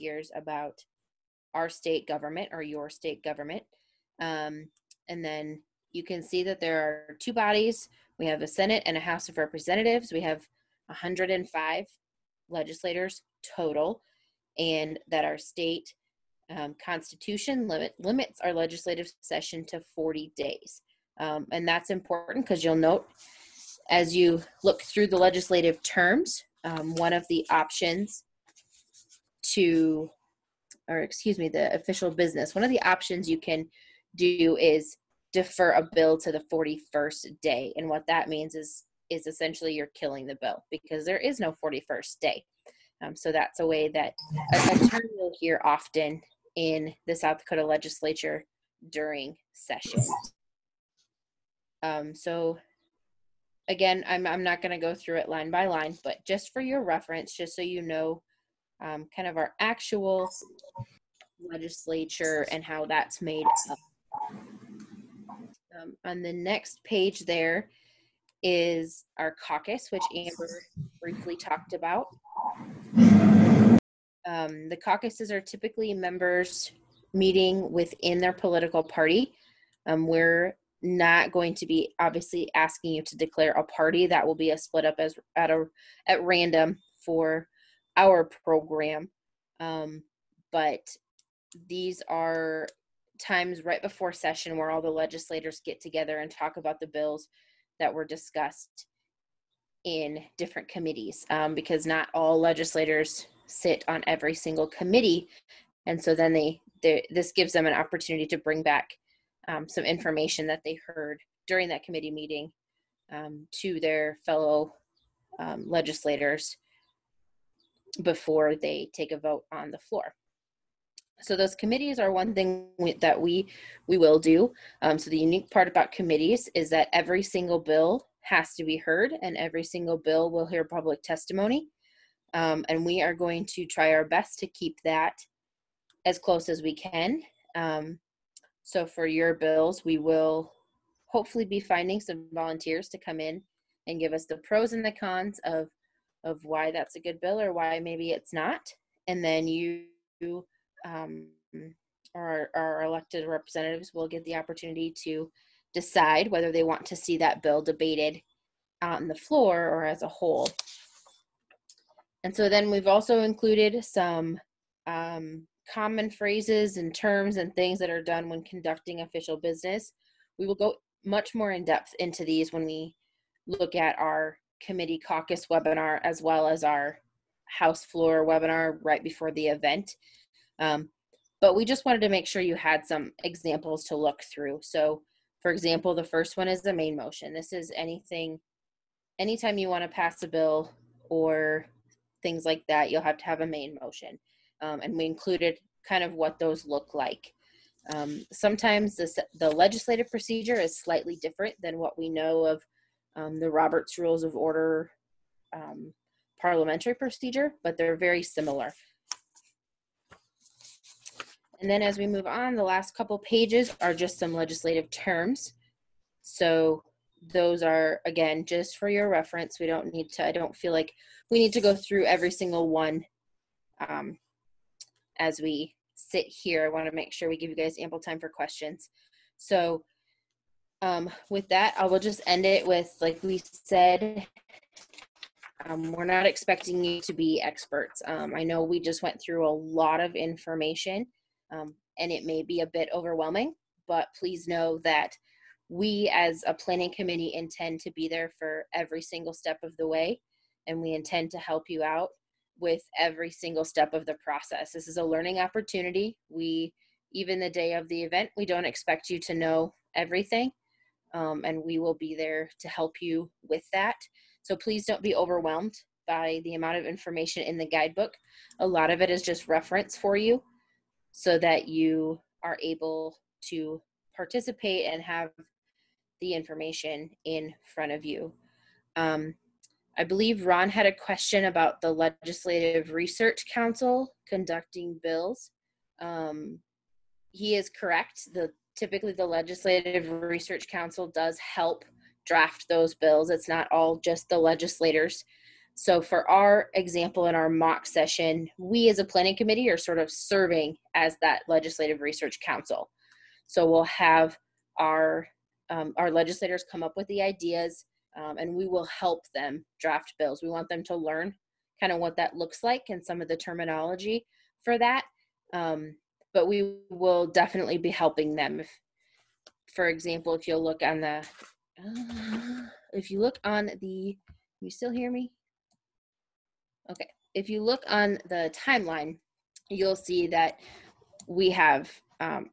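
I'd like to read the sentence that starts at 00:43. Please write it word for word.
Um, so that's a way that a, a term you'll hear often in the South Dakota legislature during session.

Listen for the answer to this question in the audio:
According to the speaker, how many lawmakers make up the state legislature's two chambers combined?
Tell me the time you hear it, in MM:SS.
00:10.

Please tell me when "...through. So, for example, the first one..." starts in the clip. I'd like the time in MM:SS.
03:04.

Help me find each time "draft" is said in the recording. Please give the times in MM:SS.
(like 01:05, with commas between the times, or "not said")
04:52, 05:09.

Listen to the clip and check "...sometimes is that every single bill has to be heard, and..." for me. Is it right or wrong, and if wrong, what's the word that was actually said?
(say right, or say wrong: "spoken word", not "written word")
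wrong: "committees", not "sometimes".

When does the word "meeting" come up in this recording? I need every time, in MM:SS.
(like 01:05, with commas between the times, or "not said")
01:17, 01:52.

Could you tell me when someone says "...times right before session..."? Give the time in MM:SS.
01:33.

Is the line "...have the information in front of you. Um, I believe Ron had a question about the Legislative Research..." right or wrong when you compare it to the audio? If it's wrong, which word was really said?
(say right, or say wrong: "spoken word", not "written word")
right.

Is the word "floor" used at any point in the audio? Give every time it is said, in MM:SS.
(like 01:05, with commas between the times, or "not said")
01:59, 02:39, 02:57.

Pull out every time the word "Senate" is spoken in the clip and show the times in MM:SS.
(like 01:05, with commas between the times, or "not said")
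00:08.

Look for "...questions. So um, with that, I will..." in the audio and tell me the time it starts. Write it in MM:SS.
03:48.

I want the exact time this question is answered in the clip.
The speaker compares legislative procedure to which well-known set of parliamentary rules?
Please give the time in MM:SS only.
03:23.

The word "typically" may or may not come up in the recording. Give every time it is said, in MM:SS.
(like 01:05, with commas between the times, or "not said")
01:15, 04:48.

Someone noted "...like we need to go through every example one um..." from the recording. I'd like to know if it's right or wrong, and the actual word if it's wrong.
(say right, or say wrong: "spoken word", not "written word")
wrong: "single", not "example".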